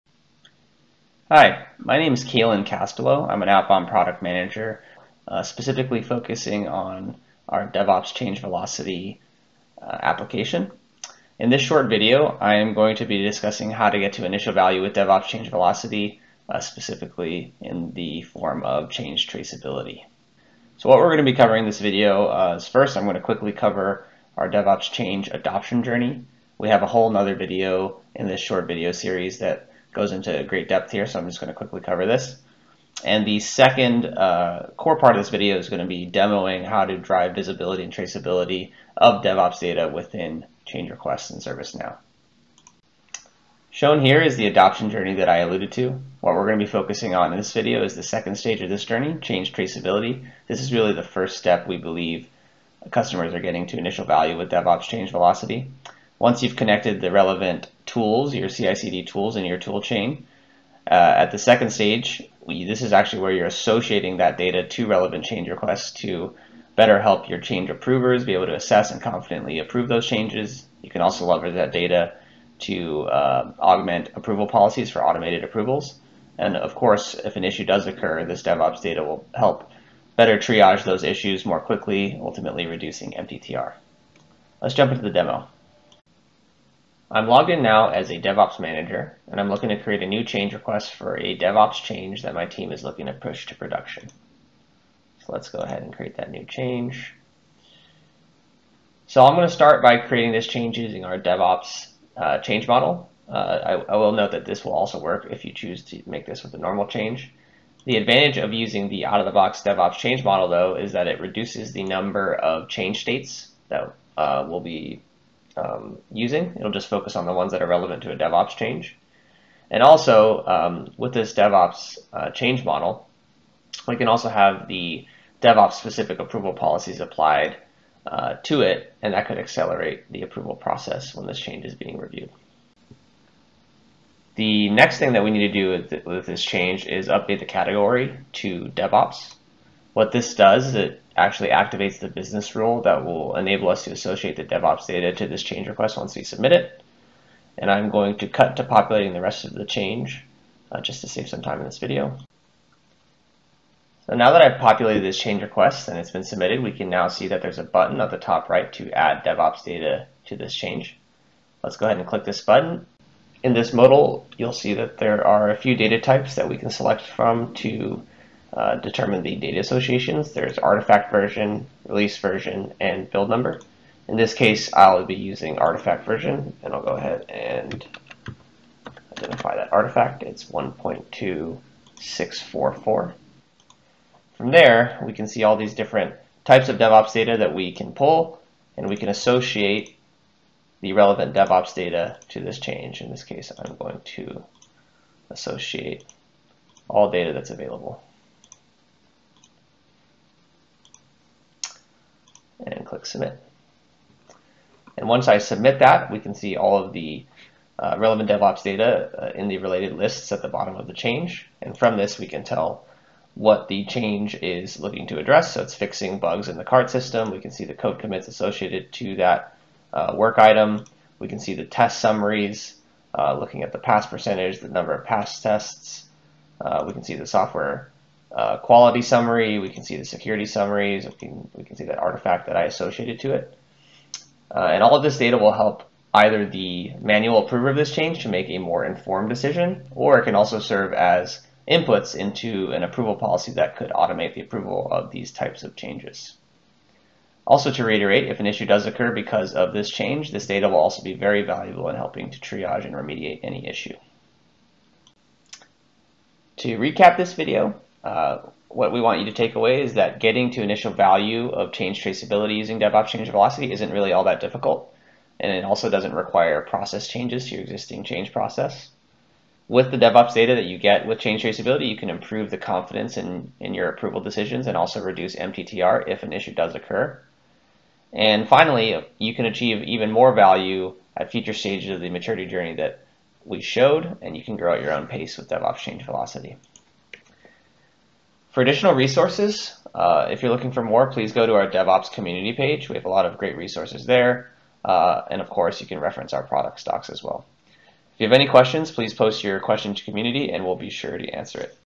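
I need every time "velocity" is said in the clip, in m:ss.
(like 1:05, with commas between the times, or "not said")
0:08, 0:15, 0:55, 4:23, 4:46.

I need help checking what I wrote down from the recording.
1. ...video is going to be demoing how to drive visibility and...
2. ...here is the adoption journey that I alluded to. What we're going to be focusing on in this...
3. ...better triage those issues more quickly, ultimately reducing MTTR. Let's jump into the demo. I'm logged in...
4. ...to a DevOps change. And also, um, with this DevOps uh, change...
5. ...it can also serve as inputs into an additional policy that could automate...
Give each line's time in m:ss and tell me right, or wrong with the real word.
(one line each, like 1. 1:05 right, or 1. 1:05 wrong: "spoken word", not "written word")
1. 0:35 right
2. 0:44 right
3. 1:20 right
4. 1:58 right
5. 4:00 wrong: "approval", not "additional".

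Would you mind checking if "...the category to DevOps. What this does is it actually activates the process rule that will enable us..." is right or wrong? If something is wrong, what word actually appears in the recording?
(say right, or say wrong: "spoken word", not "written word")
wrong: "business", not "process".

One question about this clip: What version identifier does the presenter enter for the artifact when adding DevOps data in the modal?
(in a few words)
1.2644.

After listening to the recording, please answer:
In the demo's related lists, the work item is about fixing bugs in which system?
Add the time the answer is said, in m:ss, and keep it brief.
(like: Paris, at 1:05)
The cart system, at 3:36.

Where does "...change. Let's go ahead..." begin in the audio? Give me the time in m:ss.
2:40.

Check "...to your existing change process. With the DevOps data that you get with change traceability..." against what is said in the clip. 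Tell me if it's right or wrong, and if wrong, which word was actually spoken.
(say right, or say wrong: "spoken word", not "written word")
right.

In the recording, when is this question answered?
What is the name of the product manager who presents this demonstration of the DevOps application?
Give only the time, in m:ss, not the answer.
0:02.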